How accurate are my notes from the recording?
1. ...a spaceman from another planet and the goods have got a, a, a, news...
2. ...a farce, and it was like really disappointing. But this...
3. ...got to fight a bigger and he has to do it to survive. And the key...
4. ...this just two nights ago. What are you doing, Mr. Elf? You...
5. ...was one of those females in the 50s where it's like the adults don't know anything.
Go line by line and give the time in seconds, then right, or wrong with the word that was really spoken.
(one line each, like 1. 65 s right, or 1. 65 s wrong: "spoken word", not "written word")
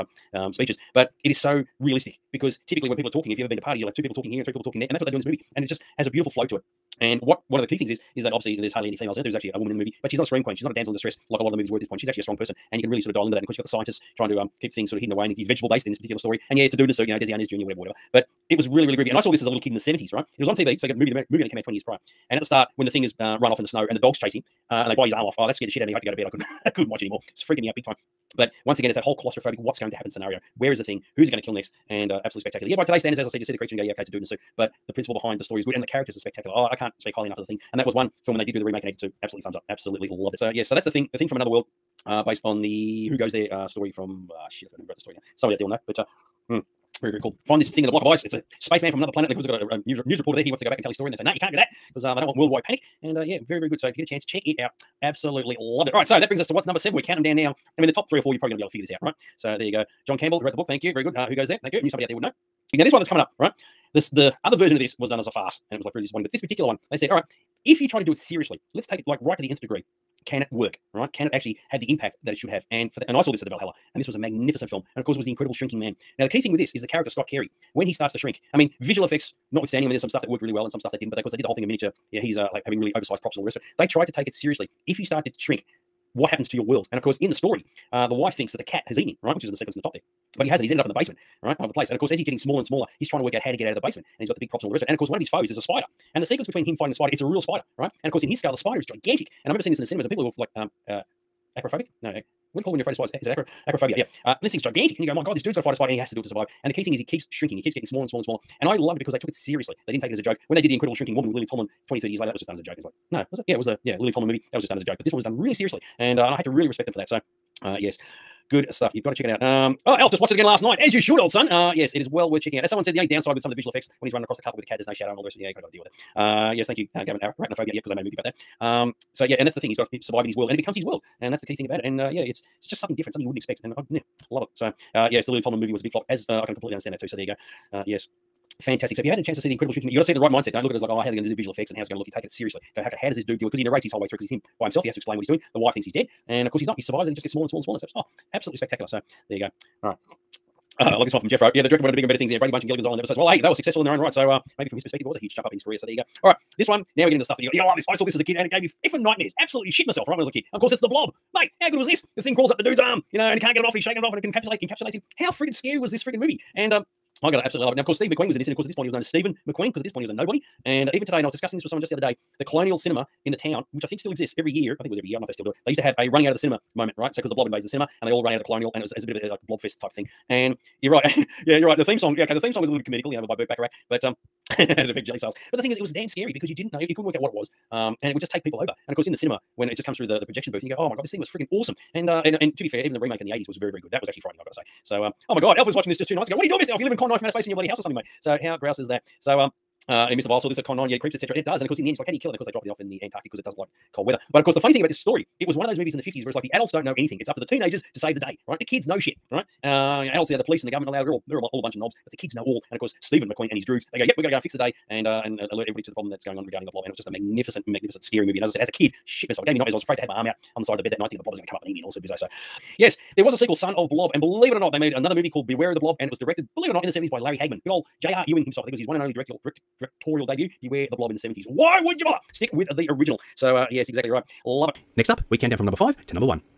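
1. 48 s right
2. 65 s right
3. 105 s wrong: "spider", not "bigger"
4. 195 s right
5. 205 s wrong: "movies", not "females".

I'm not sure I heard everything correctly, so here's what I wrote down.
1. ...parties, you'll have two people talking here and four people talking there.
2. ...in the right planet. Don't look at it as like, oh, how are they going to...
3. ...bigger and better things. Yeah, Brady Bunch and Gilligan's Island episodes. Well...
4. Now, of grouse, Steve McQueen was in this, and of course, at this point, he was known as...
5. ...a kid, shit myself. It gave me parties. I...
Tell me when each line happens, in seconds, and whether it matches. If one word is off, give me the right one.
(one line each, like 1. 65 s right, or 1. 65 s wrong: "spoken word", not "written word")
1. 3 s wrong: "three", not "four"
2. 140 s wrong: "mindset", not "planet"
3. 151 s right
4. 167 s wrong: "course", not "grouse"
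5. 218 s wrong: "nightmares", not "parties".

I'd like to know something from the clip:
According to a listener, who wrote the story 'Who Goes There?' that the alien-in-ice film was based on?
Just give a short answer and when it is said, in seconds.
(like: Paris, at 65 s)
John Campbell, at 60 s.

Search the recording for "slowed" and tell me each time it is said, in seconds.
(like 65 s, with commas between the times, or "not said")
not said.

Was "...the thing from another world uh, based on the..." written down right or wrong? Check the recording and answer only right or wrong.
right.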